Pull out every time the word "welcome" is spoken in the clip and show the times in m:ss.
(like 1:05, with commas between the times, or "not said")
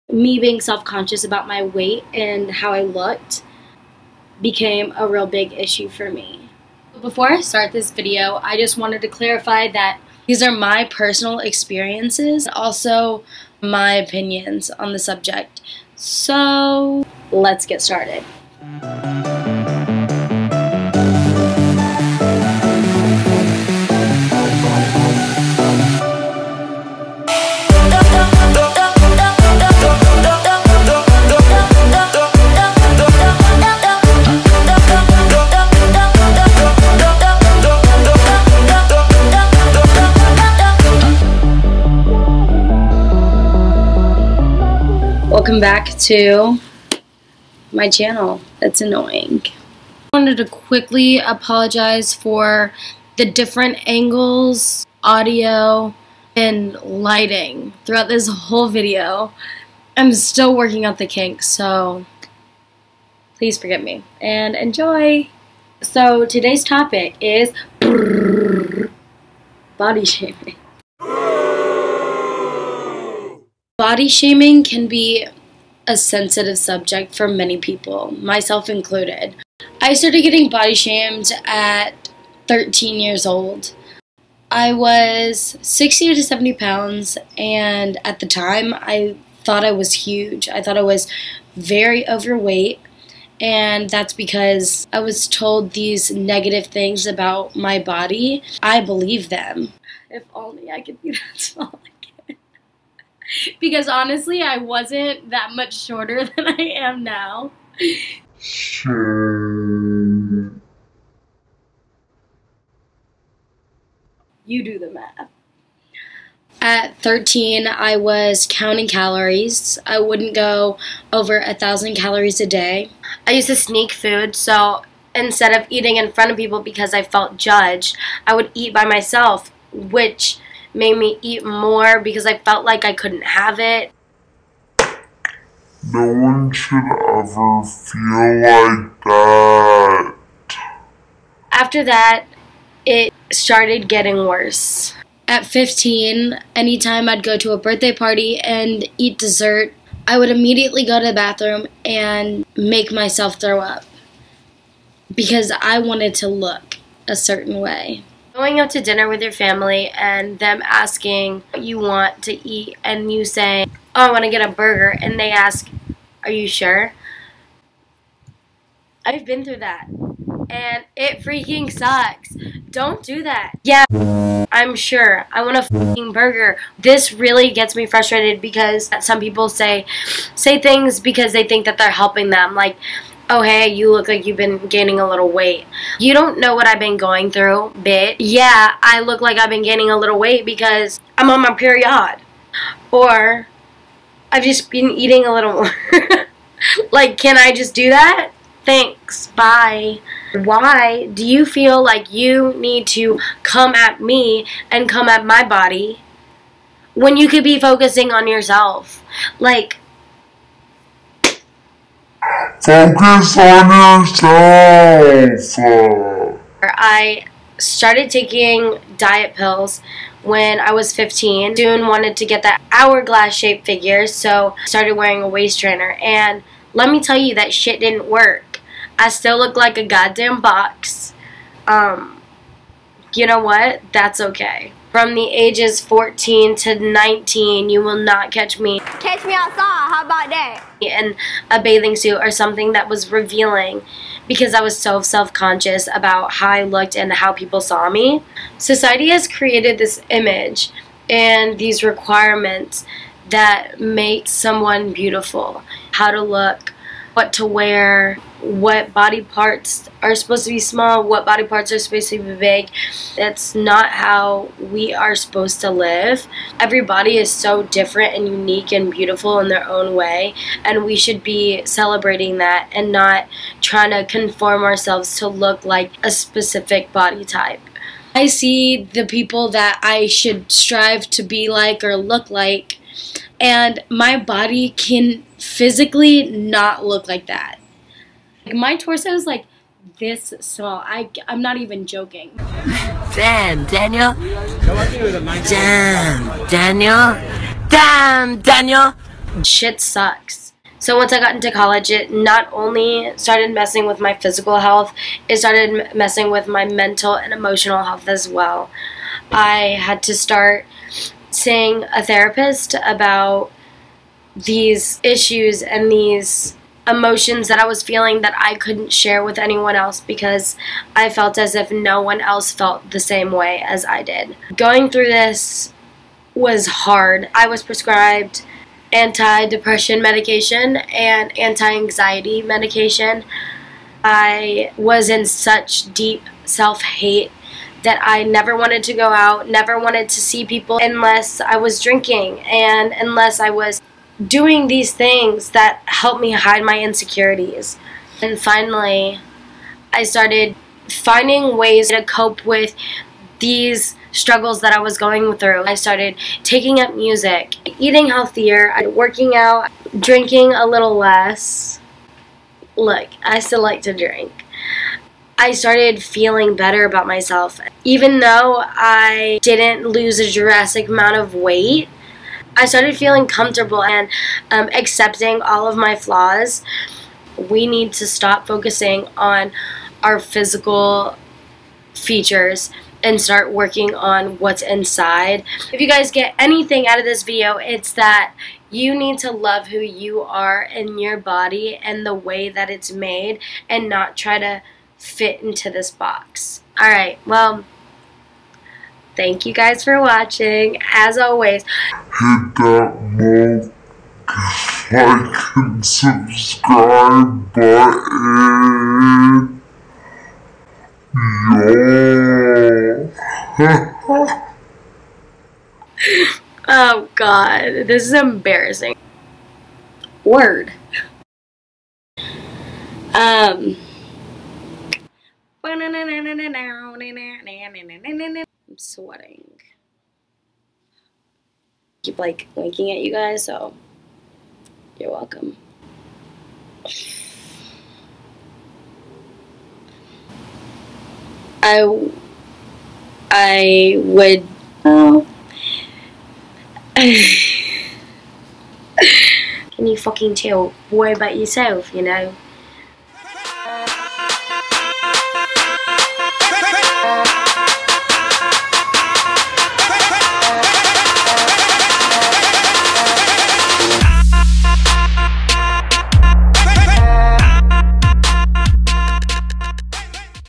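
0:45, 7:15.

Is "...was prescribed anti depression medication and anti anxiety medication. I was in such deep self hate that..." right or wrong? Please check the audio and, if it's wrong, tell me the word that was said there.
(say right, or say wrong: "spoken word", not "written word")
right.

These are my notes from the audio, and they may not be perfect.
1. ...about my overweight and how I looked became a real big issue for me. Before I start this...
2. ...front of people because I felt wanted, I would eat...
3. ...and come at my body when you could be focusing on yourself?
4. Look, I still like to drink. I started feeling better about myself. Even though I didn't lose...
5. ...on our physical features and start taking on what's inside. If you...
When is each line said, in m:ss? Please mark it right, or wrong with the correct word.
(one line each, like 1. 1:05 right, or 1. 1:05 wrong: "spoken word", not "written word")
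1. 0:01 wrong: "weight", not "overweight"
2. 2:06 wrong: "judged", not "wanted"
3. 3:24 right
4. 6:02 right
5. 6:19 wrong: "working", not "taking".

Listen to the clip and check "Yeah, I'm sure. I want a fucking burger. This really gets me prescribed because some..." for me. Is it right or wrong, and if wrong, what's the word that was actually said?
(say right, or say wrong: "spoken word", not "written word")
wrong: "frustrated", not "prescribed".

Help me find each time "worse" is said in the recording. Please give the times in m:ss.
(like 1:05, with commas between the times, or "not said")
2:24.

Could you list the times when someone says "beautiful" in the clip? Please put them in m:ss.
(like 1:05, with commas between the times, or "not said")
4:14, 4:28.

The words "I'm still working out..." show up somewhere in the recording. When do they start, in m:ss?
0:59.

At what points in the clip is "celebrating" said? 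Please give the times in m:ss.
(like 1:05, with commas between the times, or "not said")
4:31.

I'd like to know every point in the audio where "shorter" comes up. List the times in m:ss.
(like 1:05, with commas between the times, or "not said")
1:45.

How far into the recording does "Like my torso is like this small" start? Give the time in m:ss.
4:48.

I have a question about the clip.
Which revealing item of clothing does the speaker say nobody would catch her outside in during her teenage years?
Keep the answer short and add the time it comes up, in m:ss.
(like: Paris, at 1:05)
Bathing suit, at 4:01.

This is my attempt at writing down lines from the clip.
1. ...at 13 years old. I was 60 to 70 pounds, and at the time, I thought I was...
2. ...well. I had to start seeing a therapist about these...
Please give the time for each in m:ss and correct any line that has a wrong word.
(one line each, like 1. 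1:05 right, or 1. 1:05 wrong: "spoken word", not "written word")
1. 1:21 right
2. 5:08 right.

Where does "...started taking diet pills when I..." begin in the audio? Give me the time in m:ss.
3:37.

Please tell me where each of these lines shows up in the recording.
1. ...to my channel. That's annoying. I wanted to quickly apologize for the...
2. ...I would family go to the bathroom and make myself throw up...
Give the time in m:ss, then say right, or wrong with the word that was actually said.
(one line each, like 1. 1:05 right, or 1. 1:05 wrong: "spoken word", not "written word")
1. 0:45 right
2. 2:30 wrong: "immediately", not "family".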